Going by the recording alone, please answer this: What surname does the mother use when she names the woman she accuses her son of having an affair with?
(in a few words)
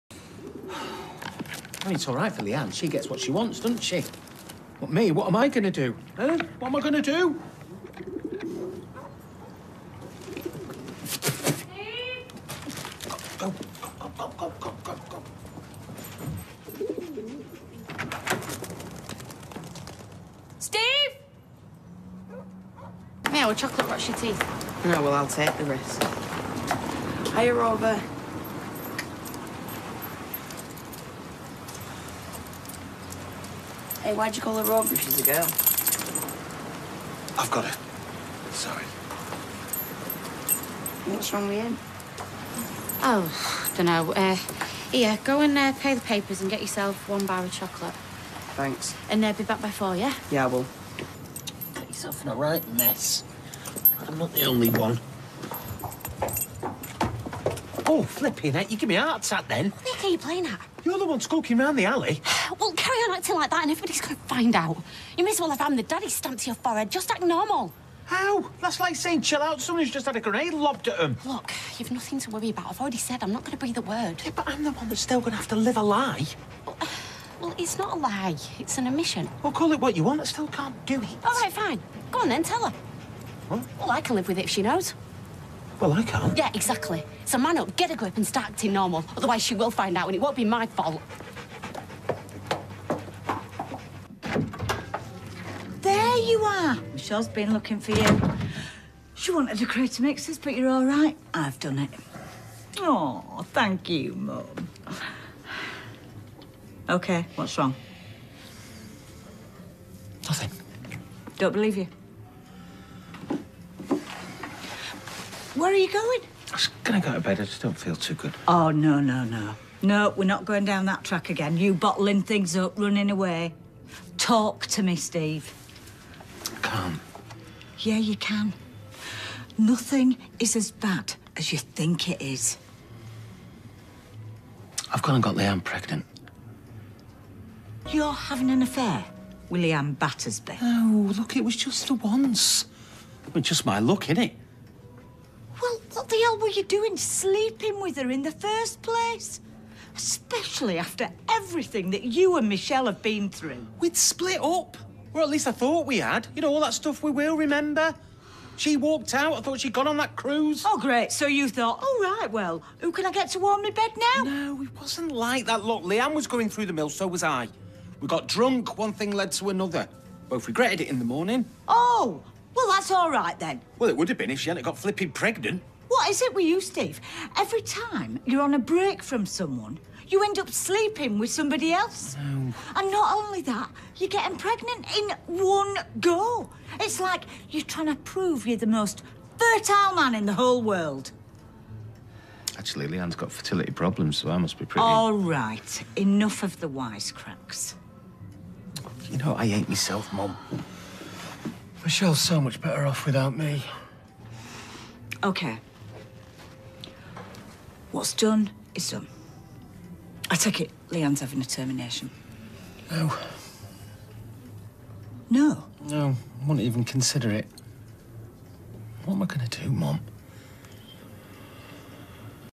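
Battersby.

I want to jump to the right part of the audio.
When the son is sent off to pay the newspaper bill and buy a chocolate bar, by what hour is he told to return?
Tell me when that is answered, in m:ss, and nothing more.
0:49.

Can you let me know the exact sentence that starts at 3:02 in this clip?
And not only that, you're getting pregnant in one go.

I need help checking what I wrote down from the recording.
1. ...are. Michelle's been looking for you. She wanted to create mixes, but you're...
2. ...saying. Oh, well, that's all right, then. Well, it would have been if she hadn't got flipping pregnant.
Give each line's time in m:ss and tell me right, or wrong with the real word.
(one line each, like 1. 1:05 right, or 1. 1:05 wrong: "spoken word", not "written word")
1. 1:36 right
2. 2:51 wrong: "morning", not "saying".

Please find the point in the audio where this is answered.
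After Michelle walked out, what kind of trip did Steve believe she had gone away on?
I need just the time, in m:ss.
2:40.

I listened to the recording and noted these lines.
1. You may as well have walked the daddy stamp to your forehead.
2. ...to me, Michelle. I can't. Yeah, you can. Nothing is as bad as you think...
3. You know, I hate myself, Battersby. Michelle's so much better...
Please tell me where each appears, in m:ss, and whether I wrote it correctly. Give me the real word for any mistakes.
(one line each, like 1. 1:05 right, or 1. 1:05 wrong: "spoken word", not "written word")
1. 1:05 wrong: "rammed", not "walked"
2. 2:04 wrong: "Steve", not "Michelle"
3. 3:19 wrong: "Mum", not "Battersby".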